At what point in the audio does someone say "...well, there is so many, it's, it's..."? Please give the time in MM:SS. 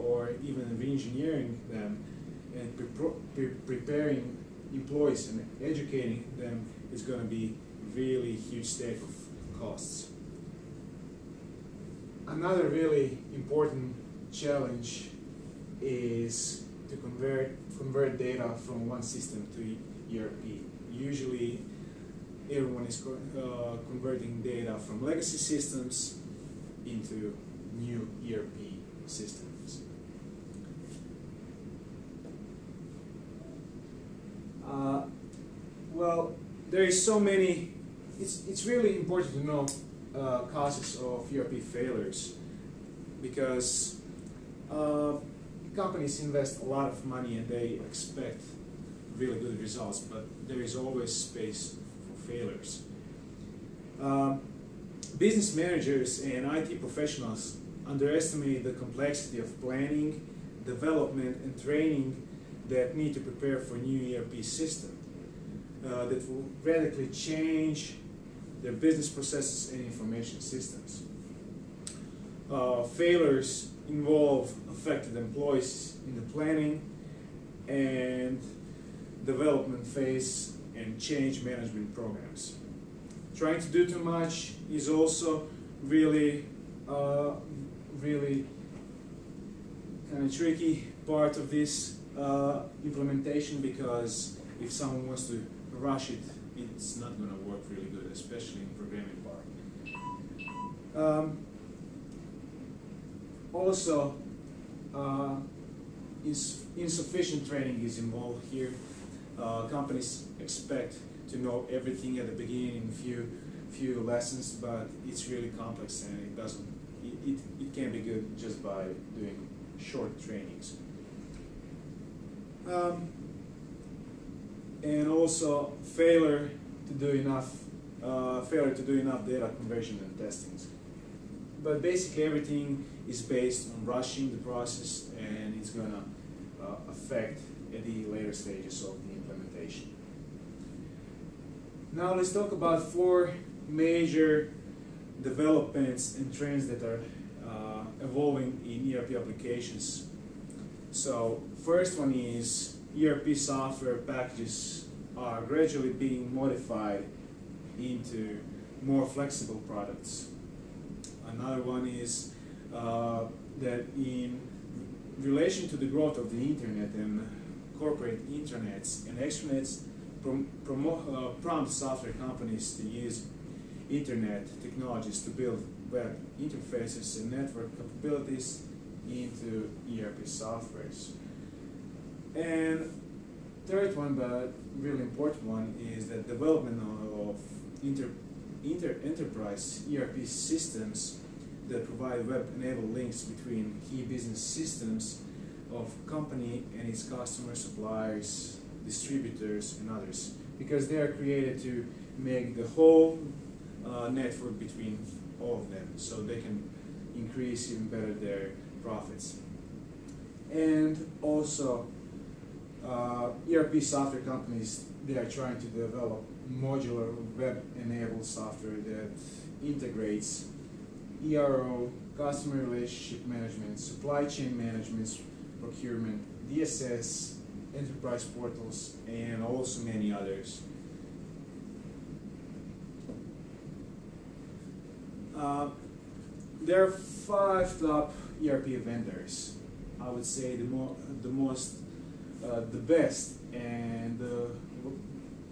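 00:35.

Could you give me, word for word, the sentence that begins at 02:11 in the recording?
But basically everything is based on rushing the process and it's gonna uh, affect at the later stages of the implementation.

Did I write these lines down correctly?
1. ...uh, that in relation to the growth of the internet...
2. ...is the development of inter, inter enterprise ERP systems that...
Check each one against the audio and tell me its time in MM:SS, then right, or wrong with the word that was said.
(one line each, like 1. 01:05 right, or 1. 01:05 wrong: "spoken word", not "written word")
1. 02:42 right
2. 03:05 right.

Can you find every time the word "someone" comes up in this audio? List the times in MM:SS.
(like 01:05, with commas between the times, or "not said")
01:34.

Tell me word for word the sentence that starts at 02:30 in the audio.
So first one is ERP software packages are gradually being modified into more flexible products.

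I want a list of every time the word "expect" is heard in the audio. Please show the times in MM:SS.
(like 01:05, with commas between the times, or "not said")
00:47, 01:50.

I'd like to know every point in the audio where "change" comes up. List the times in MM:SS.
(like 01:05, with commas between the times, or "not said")
01:07, 01:20.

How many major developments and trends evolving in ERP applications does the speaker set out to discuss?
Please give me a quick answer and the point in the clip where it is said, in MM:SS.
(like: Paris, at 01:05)
4, at 02:22.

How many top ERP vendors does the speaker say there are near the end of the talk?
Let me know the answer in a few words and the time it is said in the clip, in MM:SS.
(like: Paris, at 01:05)
5, at 03:56.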